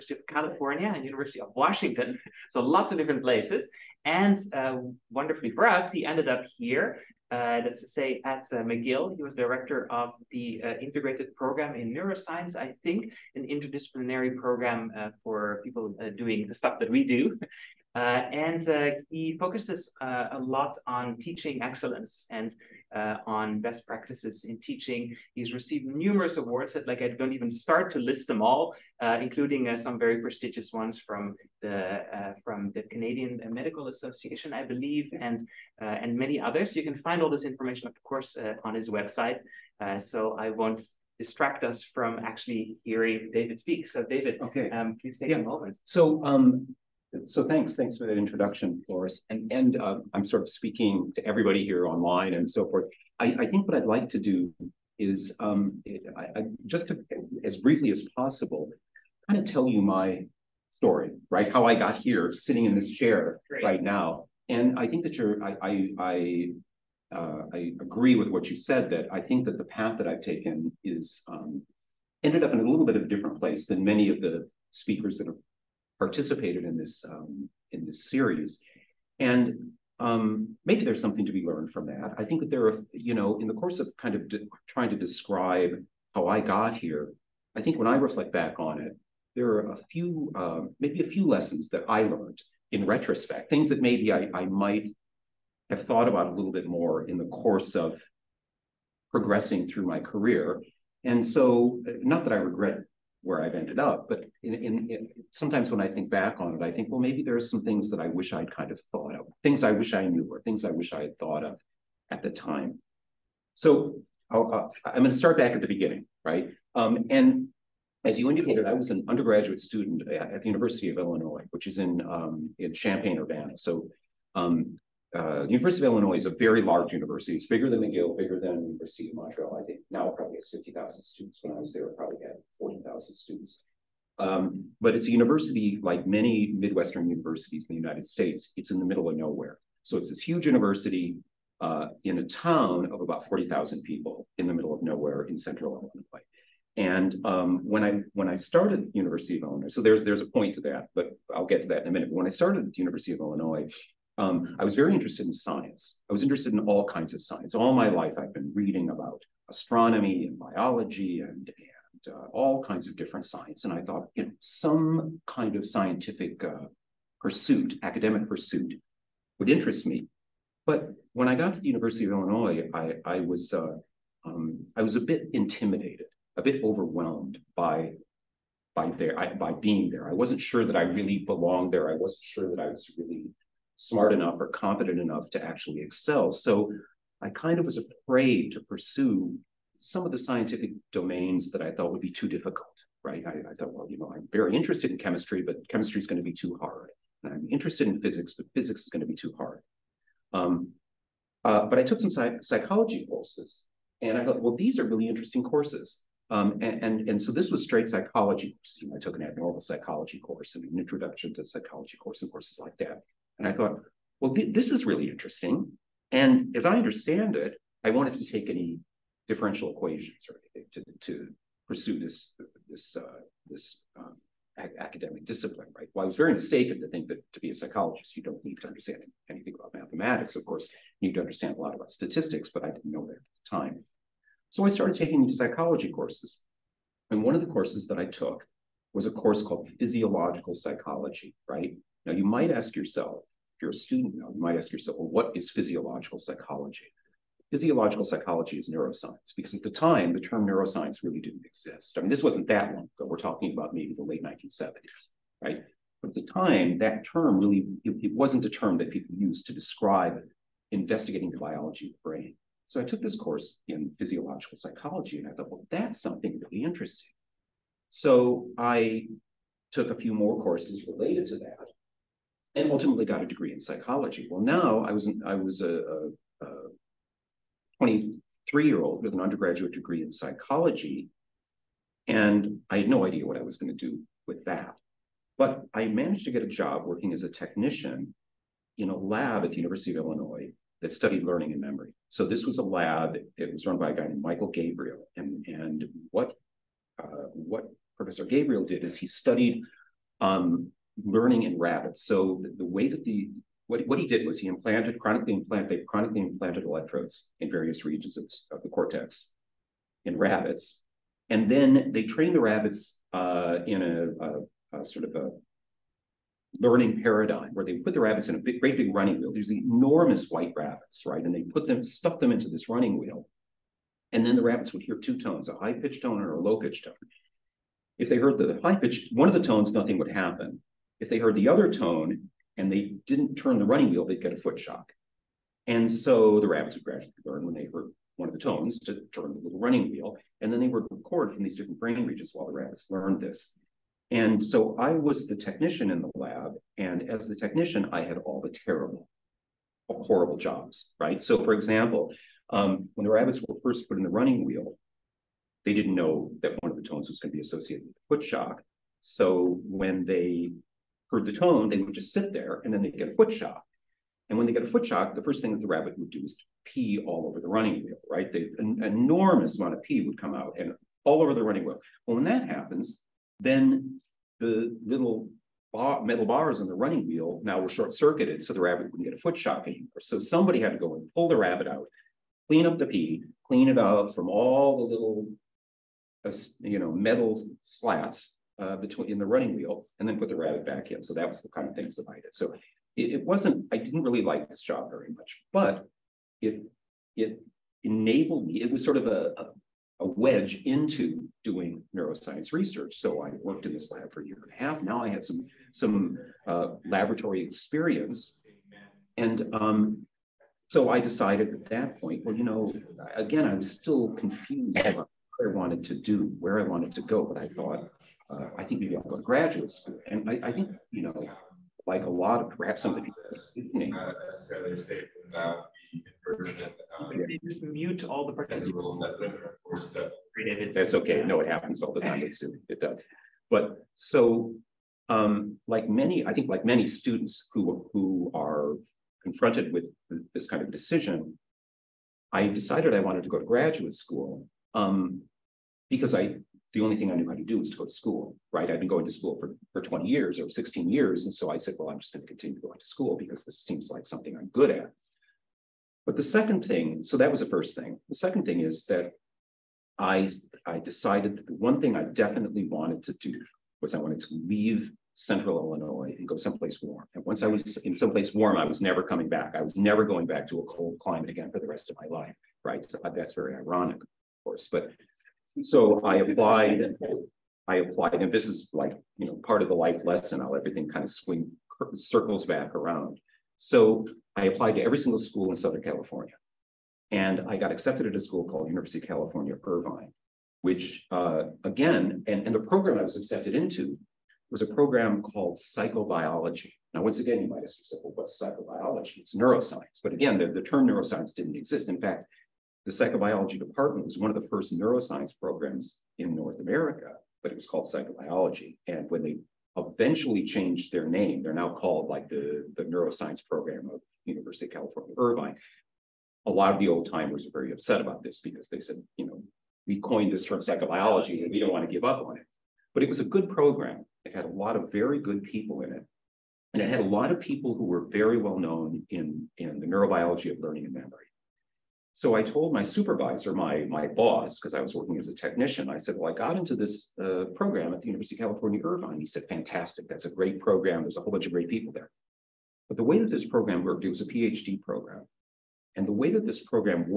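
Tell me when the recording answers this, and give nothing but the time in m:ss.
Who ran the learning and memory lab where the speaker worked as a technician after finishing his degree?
4:54.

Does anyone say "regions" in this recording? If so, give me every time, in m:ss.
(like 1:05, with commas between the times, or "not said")
5:07, 5:42.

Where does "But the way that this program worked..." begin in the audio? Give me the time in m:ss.
9:02.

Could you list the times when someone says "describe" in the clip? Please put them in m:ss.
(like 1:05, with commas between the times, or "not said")
1:24, 4:19.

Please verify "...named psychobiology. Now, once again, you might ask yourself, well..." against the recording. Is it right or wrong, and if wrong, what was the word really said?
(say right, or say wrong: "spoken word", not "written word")
wrong: "called", not "named".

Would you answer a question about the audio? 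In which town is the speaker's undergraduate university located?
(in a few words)
Champaign, Urbana.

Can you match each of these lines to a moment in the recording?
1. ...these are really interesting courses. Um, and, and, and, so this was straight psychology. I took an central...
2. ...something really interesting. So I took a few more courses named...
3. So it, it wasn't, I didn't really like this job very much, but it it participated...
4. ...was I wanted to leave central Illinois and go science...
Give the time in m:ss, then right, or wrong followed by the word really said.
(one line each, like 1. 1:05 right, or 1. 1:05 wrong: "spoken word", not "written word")
1. 3:24 wrong: "abnormal", not "central"
2. 4:26 wrong: "related", not "named"
3. 6:32 wrong: "enabled", not "participated"
4. 7:43 wrong: "someplace", not "science".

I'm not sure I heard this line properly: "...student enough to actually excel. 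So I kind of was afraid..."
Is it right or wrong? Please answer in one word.
wrong.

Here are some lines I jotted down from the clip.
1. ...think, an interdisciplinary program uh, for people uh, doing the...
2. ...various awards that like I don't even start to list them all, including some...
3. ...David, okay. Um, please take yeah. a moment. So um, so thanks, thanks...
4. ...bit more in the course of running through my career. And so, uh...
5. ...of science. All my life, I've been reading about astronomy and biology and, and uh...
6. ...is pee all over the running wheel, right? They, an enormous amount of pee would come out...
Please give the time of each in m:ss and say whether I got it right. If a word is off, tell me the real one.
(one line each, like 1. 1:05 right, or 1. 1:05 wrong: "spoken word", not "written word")
1. 0:12 right
2. 0:25 wrong: "numerous", not "various"
3. 0:44 right
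4. 1:36 wrong: "progressing", not "running"
5. 2:37 right
6. 6:06 right.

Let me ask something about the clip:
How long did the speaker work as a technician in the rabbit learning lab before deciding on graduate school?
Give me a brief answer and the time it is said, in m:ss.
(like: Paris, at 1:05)
a year and a half, at 6:44.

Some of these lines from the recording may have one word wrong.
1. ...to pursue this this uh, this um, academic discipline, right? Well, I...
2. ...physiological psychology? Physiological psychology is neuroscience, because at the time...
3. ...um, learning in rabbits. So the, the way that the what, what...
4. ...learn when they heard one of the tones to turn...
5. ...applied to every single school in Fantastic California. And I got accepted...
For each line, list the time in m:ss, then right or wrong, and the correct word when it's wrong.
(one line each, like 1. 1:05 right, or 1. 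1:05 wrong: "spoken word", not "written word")
1. 3:41 right
2. 4:05 right
3. 5:00 right
4. 5:37 right
5. 8:04 wrong: "Southern", not "Fantastic".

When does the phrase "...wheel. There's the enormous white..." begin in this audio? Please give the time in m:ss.
5:19.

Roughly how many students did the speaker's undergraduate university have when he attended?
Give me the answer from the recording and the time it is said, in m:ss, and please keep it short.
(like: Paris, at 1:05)
40,000, at 2:12.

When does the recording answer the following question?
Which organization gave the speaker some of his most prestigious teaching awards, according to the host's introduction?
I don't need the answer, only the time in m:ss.
0:32.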